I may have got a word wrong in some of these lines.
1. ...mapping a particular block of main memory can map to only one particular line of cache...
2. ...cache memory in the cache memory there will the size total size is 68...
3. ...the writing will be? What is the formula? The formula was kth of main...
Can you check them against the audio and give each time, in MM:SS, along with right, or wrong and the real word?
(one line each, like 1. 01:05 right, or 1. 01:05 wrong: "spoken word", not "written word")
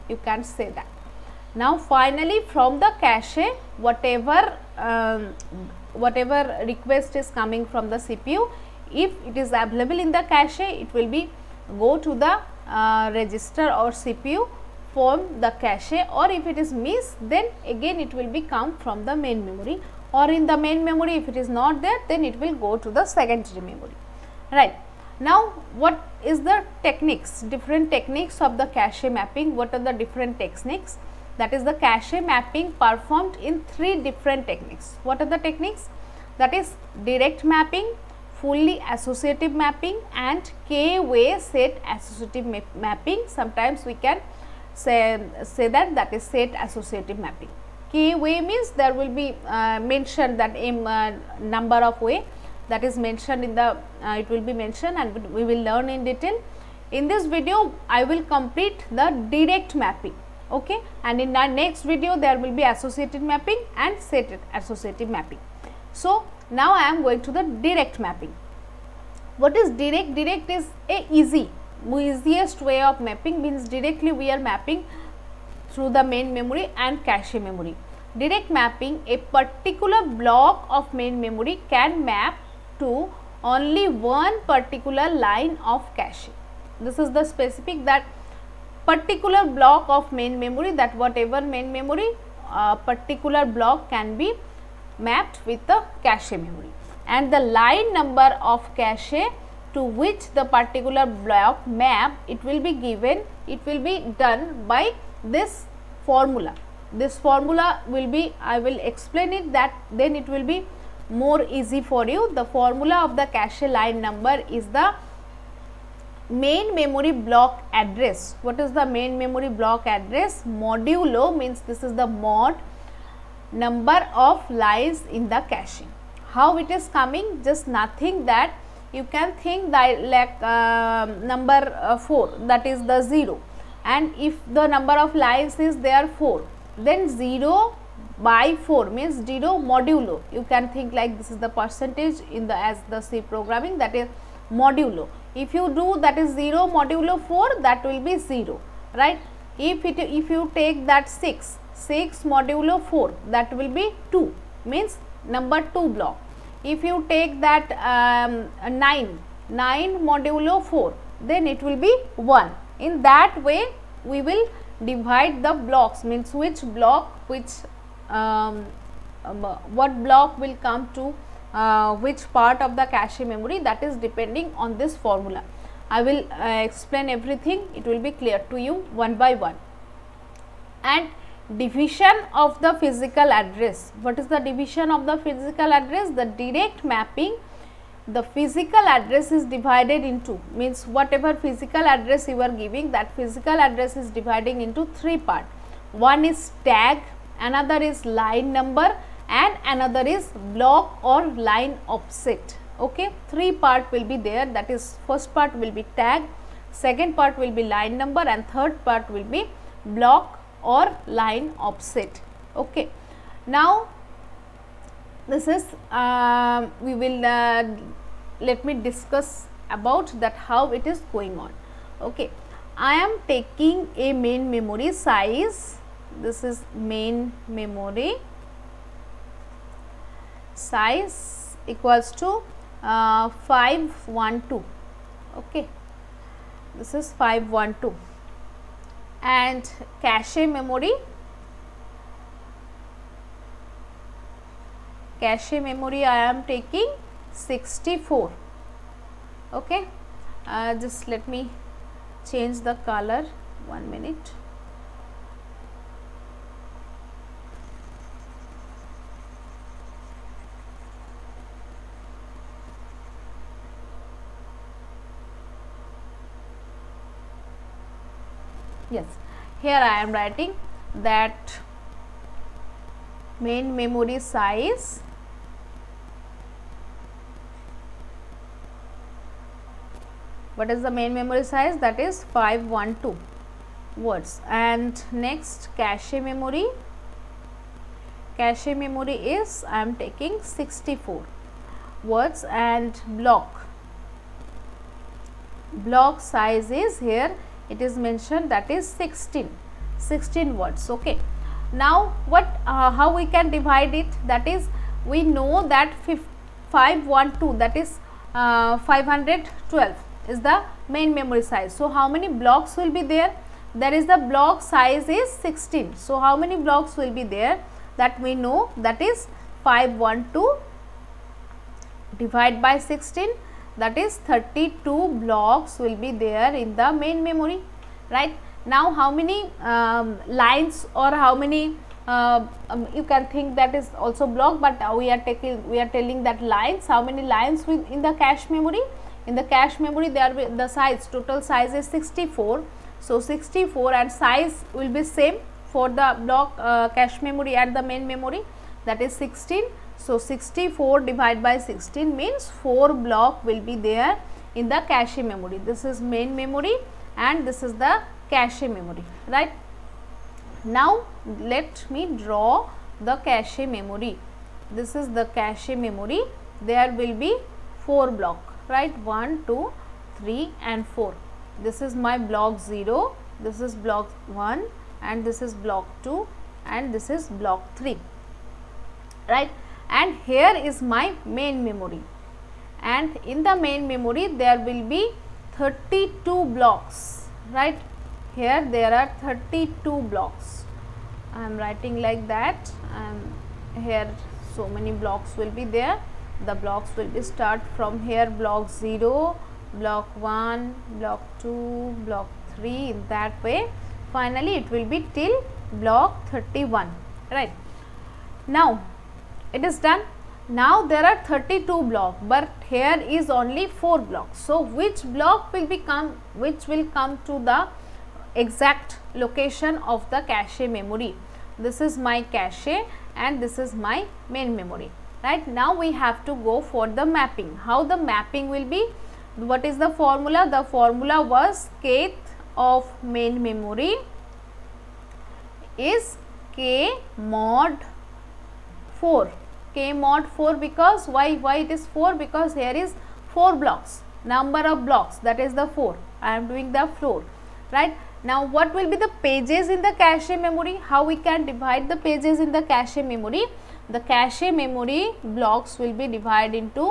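1. 01:18 right
2. 05:38 wrong: "64", not "68"
3. 07:07 wrong: "mapping", not "writing".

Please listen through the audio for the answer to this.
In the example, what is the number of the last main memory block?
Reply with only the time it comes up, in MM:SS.
06:45.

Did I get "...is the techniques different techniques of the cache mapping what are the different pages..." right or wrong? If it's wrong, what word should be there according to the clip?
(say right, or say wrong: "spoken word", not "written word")
wrong: "techniques", not "pages".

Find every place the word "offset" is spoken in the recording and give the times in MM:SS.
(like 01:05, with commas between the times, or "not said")
03:21, 03:31.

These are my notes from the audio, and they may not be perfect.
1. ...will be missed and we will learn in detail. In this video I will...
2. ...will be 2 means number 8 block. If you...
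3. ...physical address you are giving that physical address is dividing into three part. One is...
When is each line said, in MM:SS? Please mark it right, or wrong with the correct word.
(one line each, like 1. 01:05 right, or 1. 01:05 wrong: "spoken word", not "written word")
1. 00:54 wrong: "mentioned", not "missed"
2. 02:33 wrong: "2", not "8"
3. 03:11 right.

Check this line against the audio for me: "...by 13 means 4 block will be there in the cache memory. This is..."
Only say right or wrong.
wrong.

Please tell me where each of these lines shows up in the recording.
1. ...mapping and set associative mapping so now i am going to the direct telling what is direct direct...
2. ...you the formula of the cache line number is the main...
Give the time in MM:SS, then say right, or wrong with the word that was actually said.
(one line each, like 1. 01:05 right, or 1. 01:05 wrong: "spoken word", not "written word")
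1. 01:03 wrong: "mapping", not "telling"
2. 01:52 right.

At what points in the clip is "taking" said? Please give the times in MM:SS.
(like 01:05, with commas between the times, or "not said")
03:43, 04:06, 04:49, 05:35.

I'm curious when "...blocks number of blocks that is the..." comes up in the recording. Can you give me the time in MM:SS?
07:23.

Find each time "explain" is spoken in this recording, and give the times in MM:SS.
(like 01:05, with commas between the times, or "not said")
01:48, 02:56.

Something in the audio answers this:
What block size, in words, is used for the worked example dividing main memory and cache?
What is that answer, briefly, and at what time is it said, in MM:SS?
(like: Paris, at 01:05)
16 words, at 04:58.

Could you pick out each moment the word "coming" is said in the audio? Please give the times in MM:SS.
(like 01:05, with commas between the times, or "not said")
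00:07, 02:06.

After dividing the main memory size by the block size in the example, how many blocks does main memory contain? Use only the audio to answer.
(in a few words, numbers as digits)
32.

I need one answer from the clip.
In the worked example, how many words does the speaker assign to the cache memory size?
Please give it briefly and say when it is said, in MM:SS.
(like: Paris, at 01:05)
64 words, at 04:50.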